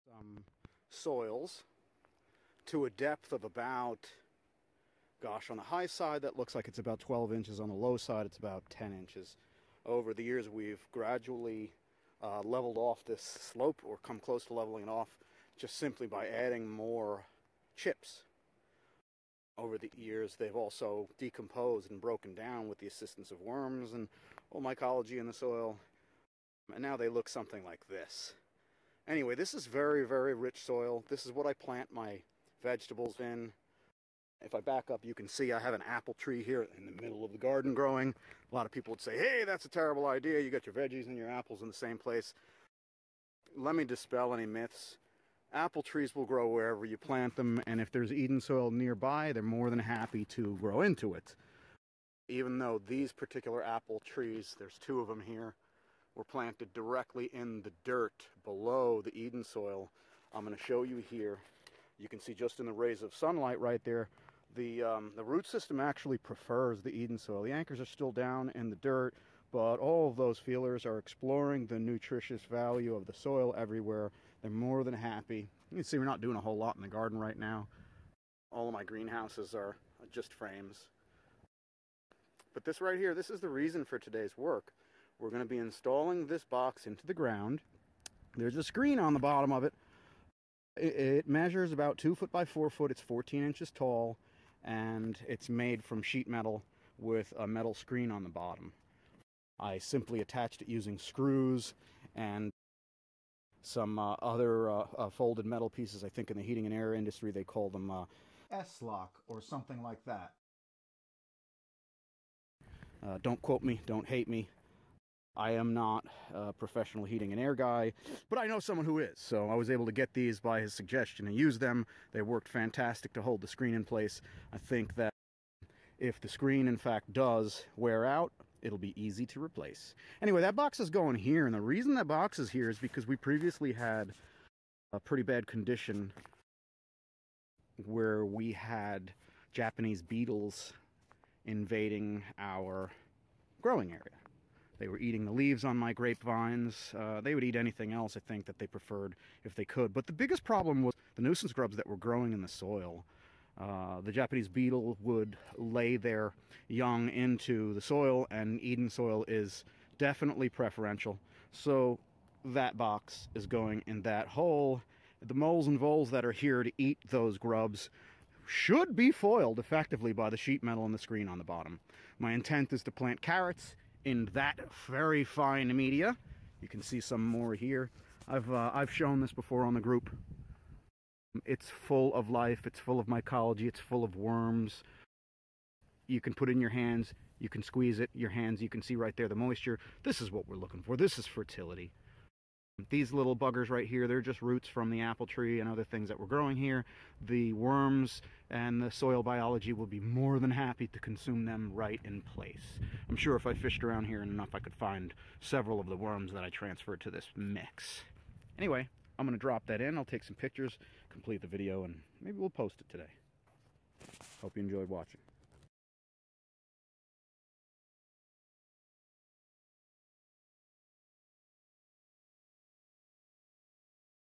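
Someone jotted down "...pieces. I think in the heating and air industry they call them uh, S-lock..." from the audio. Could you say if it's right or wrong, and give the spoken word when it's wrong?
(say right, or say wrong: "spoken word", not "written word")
right.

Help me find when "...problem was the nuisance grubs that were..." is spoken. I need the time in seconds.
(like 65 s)
150 s.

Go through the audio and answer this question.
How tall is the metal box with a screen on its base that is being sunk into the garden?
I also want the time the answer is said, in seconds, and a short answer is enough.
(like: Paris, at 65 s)
14 inches, at 93 s.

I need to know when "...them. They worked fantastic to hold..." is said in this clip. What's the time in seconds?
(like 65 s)
121 s.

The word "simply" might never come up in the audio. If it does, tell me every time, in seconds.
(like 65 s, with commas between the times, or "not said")
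15 s, 99 s.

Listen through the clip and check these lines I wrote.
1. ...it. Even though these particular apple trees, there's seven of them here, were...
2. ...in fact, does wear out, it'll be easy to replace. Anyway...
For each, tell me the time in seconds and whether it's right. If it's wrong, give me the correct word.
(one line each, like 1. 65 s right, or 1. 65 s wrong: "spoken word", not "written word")
1. 51 s wrong: "two", not "seven"
2. 126 s right.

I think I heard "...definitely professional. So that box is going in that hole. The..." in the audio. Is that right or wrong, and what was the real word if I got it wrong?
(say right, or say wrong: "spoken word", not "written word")
wrong: "preferential", not "professional".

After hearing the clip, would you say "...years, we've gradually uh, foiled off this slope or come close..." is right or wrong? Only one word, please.
wrong.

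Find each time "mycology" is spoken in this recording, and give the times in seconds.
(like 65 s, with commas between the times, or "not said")
24 s, 183 s.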